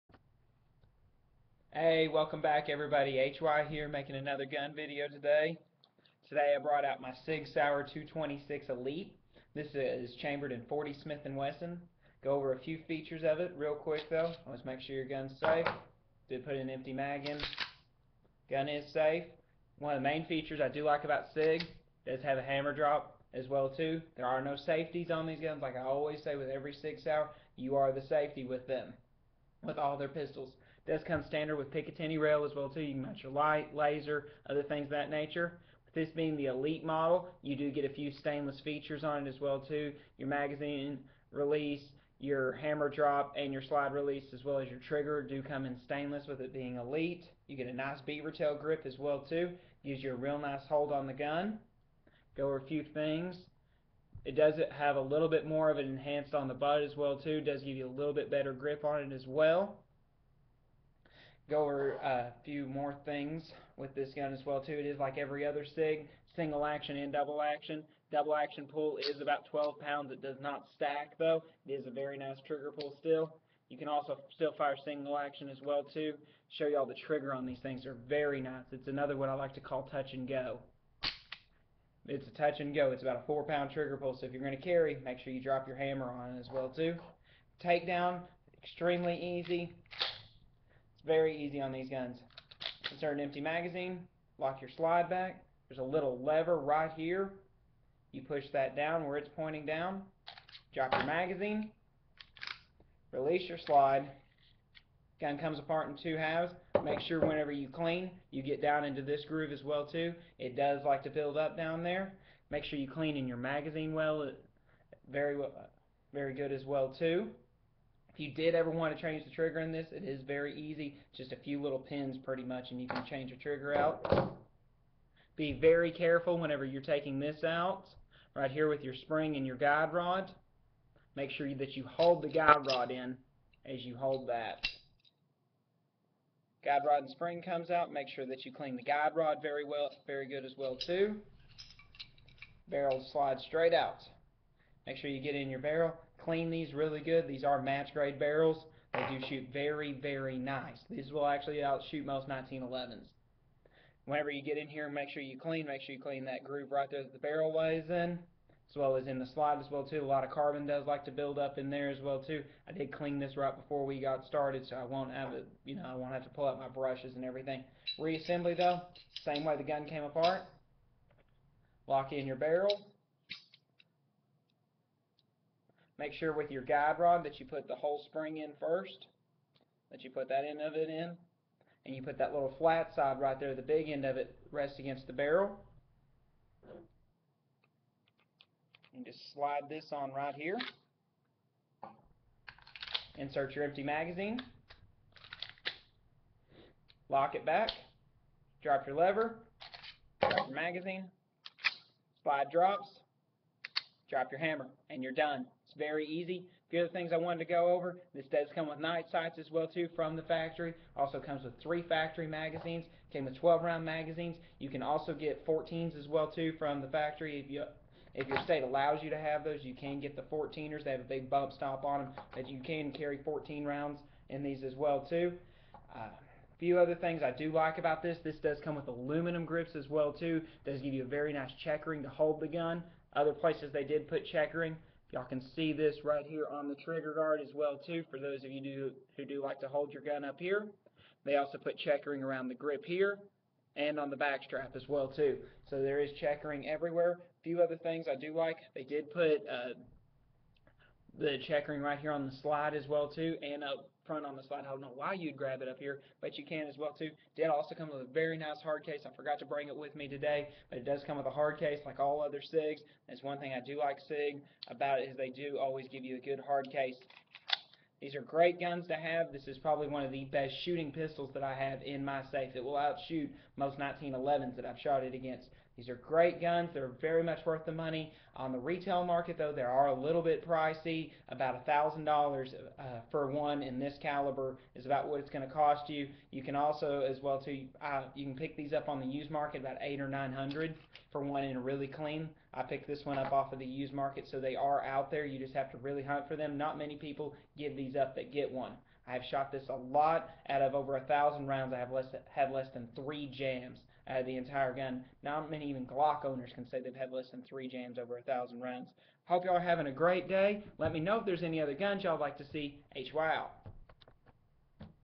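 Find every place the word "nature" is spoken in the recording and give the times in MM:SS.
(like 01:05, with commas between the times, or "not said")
00:35.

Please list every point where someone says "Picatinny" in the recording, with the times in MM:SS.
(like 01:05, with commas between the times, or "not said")
00:31.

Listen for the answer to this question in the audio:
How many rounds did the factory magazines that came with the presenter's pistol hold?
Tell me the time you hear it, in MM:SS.
03:33.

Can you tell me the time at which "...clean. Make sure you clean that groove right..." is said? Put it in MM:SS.
02:35.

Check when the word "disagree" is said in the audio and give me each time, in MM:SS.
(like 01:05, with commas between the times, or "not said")
not said.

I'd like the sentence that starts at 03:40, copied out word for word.
They have a big bump stop on them that you can carry 14 rounds in these as well too.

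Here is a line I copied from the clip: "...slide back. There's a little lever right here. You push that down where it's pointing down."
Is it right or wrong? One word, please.
right.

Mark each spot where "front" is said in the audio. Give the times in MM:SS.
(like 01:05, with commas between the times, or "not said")
04:14.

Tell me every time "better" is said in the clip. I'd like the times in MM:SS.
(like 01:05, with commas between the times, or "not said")
00:58.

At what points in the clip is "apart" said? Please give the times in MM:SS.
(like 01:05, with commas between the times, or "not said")
01:45, 02:50.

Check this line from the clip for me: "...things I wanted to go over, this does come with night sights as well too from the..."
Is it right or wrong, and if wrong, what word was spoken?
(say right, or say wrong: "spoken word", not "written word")
right.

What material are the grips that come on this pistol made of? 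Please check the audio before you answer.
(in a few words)
Aluminum.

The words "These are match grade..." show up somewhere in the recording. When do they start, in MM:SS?
02:27.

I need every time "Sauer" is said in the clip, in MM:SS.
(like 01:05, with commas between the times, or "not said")
00:07, 00:27.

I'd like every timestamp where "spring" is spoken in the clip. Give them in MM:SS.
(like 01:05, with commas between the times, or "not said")
02:08, 02:17, 02:58.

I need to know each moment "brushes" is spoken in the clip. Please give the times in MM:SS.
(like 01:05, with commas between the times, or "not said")
02:46.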